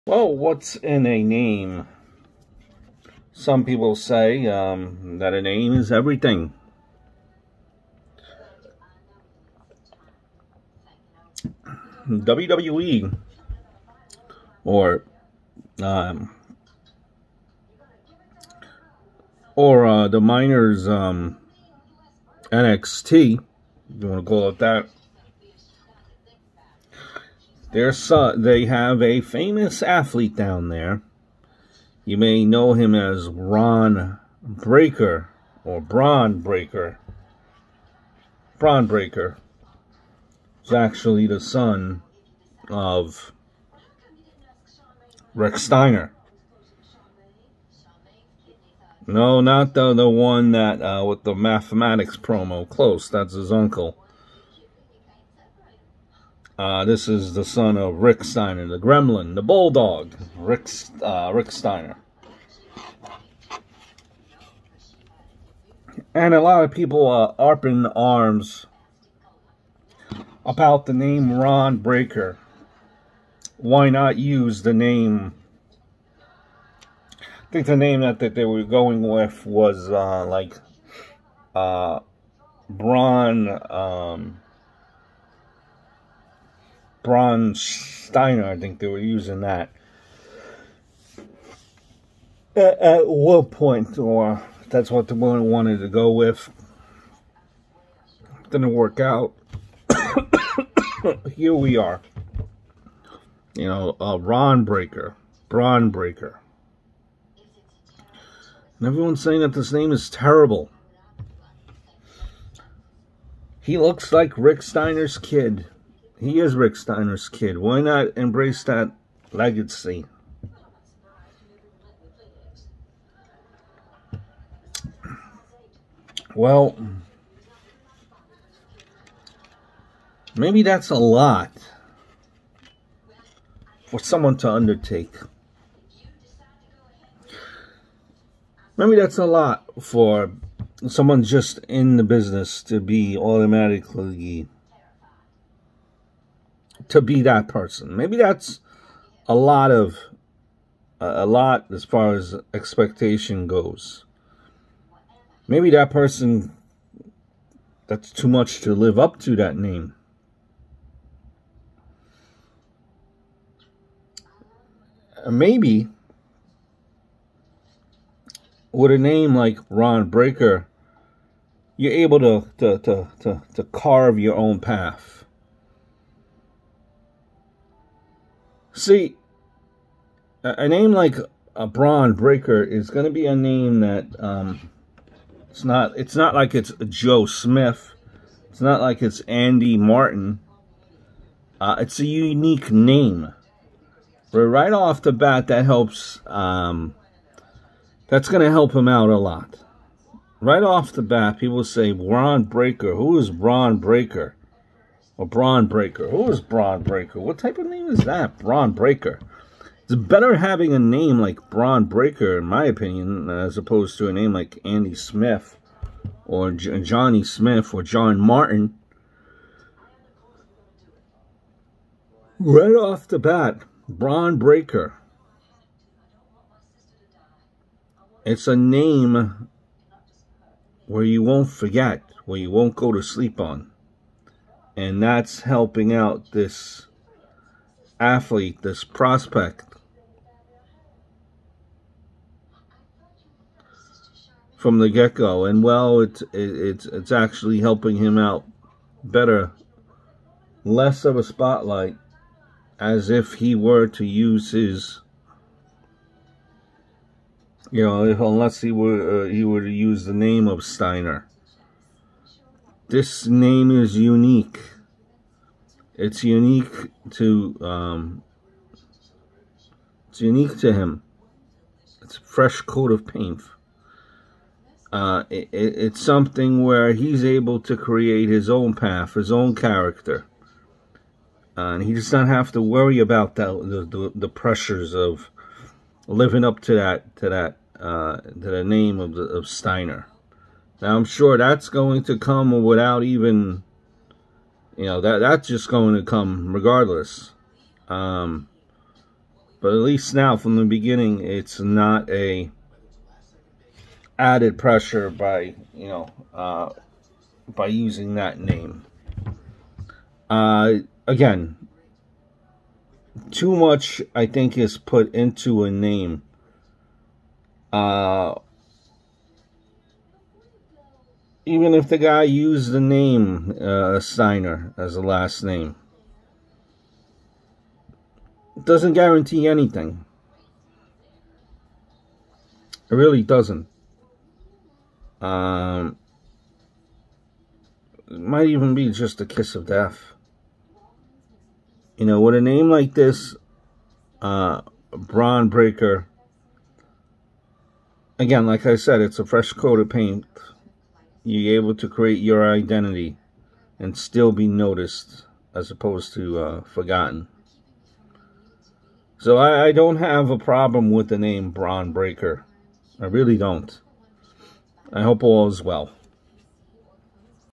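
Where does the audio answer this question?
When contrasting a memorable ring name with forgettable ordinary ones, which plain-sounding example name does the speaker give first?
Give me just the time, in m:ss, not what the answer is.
3:06.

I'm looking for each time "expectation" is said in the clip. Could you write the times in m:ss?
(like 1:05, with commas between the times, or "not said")
2:32.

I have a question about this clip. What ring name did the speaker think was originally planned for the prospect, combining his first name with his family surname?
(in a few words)
Braun Steiner.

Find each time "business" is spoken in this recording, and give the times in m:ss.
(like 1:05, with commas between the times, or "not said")
2:22.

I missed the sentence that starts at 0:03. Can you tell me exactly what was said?
Some people say um, that a name is everything.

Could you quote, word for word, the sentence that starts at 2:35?
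Maybe that person that's too much to live up to that name.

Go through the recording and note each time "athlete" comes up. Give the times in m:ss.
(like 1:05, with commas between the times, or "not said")
0:29, 3:57.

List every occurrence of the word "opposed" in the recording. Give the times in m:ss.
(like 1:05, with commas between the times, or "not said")
3:33, 5:55.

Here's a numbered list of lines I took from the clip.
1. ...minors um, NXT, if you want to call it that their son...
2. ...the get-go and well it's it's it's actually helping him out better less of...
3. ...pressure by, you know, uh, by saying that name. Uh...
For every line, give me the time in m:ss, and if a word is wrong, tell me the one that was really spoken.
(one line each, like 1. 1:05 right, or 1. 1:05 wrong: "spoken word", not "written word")
1. 0:20 right
2. 4:04 right
3. 5:04 wrong: "using", not "saying".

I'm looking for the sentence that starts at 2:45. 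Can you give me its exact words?
Maybe with a name like Ron Breakker, you're able to to to to, to carve your own path.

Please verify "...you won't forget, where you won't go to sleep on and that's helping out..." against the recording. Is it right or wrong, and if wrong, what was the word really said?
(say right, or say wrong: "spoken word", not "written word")
right.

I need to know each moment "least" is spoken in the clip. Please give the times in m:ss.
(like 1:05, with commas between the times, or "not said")
4:59.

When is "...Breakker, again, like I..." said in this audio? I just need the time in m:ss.
5:45.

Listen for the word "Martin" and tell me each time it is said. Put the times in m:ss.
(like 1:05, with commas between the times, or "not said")
3:09, 3:38.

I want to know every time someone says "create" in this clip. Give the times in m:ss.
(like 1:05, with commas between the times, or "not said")
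4:37, 5:51.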